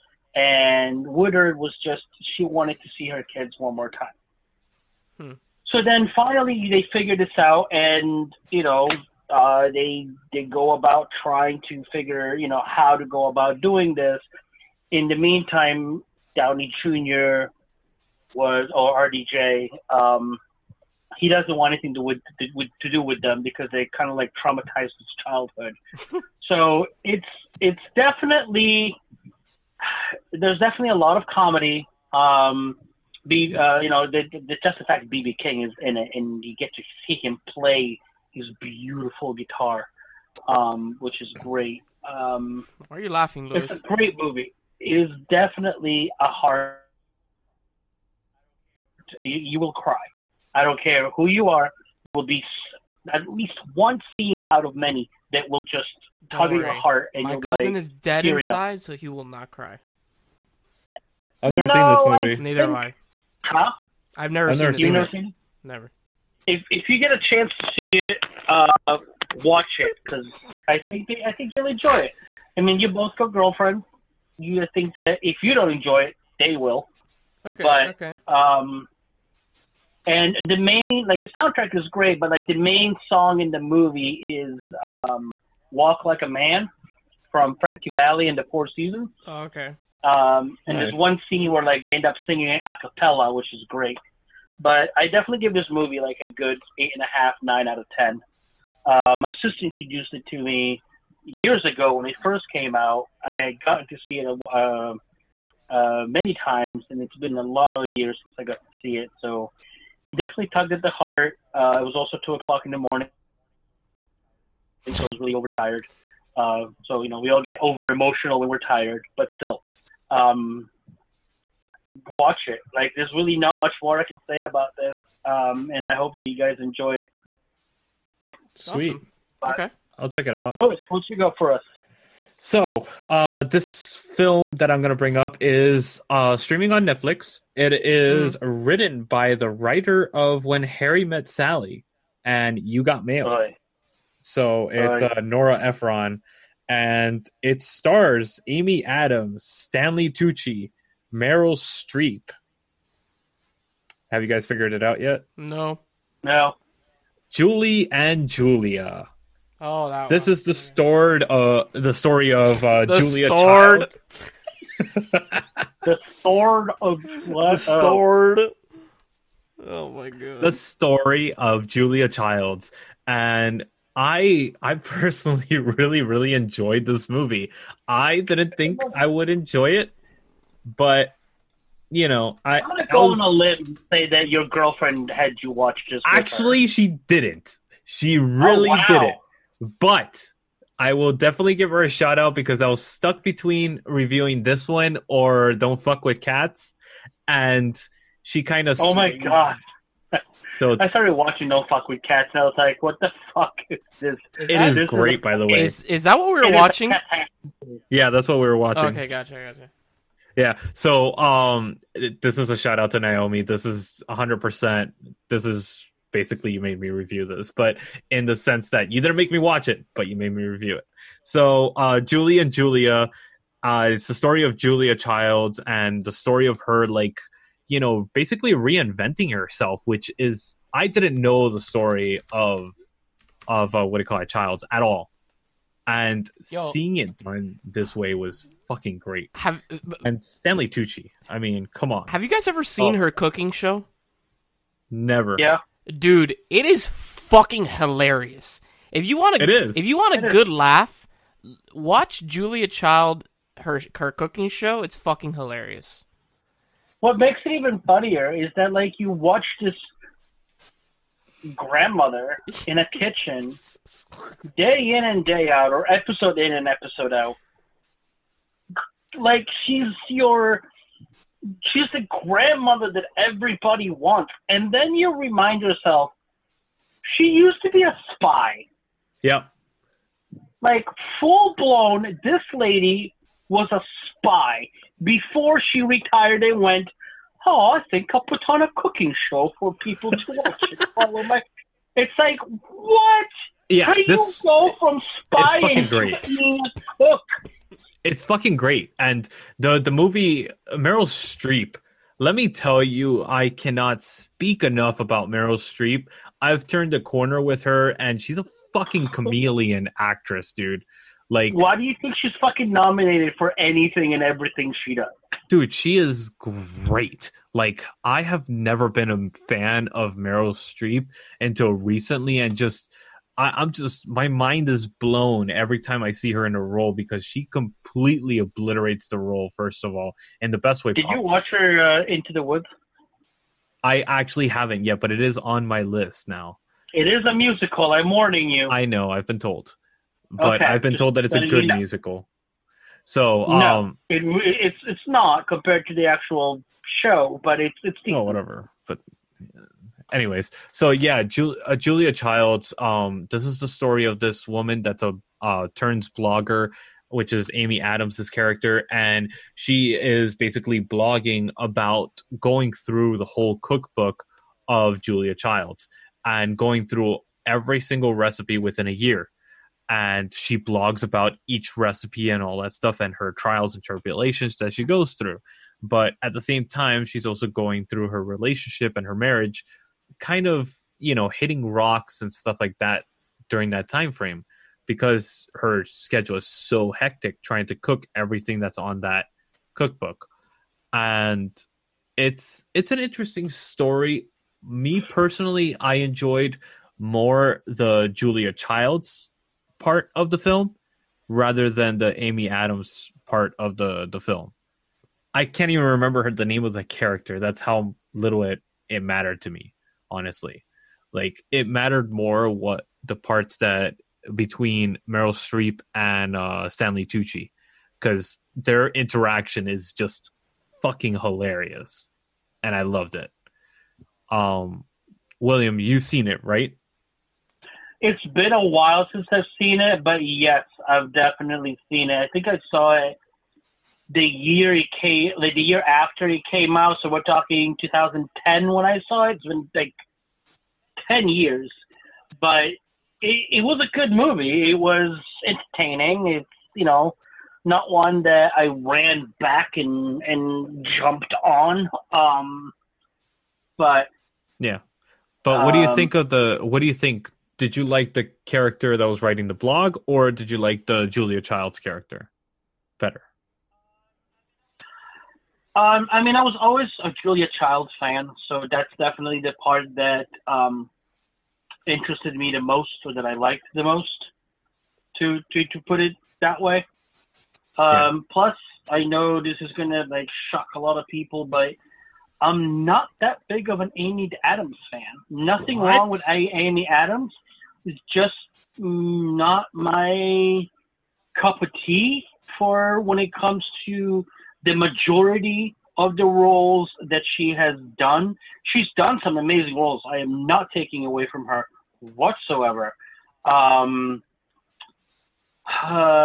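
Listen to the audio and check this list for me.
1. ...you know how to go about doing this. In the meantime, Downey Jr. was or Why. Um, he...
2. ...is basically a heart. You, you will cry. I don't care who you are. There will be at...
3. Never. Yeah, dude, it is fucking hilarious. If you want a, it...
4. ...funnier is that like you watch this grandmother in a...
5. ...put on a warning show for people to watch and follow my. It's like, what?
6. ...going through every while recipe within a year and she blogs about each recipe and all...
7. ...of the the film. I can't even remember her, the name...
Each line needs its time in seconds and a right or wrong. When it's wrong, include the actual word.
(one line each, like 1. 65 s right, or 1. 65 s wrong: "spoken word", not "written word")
1. 12 s wrong: "RDJ", not "Why"
2. 45 s wrong: "definitely", not "basically"
3. 244 s right
4. 257 s right
5. 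288 s wrong: "cooking", not "warning"
6. 366 s wrong: "single", not "while"
7. 403 s right.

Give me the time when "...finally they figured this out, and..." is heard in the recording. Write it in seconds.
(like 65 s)
6 s.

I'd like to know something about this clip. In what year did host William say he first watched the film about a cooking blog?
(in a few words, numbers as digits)
2010.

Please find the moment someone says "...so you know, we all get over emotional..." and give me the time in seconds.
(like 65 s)
116 s.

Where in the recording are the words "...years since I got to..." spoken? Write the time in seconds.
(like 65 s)
107 s.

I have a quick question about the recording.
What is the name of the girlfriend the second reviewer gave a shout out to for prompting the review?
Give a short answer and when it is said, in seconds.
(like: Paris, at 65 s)
Naomi, at 212 s.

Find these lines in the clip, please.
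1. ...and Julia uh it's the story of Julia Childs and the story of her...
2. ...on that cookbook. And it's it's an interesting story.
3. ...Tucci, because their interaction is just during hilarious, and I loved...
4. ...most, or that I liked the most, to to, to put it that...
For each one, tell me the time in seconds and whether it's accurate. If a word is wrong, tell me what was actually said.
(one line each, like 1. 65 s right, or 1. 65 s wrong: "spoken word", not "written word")
1. 222 s right
2. 388 s right
3. 417 s wrong: "fucking", not "during"
4. 472 s right.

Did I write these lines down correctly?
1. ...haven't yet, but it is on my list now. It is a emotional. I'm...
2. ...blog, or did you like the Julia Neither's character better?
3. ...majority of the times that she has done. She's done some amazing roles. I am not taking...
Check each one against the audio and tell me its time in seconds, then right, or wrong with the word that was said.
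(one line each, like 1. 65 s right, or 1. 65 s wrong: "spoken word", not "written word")
1. 334 s wrong: "musical", not "emotional"
2. 459 s wrong: "Child", not "Neither"
3. 494 s wrong: "roles", not "times".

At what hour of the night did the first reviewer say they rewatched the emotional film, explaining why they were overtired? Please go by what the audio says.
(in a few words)
2 o'clock.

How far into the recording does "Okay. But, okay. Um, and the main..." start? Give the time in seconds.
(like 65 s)
77 s.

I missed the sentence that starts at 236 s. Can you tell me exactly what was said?
seeing it done this way was fucking great.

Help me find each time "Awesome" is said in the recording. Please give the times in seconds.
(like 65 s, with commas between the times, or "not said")
129 s.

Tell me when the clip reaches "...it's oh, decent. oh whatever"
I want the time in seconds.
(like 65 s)
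347 s.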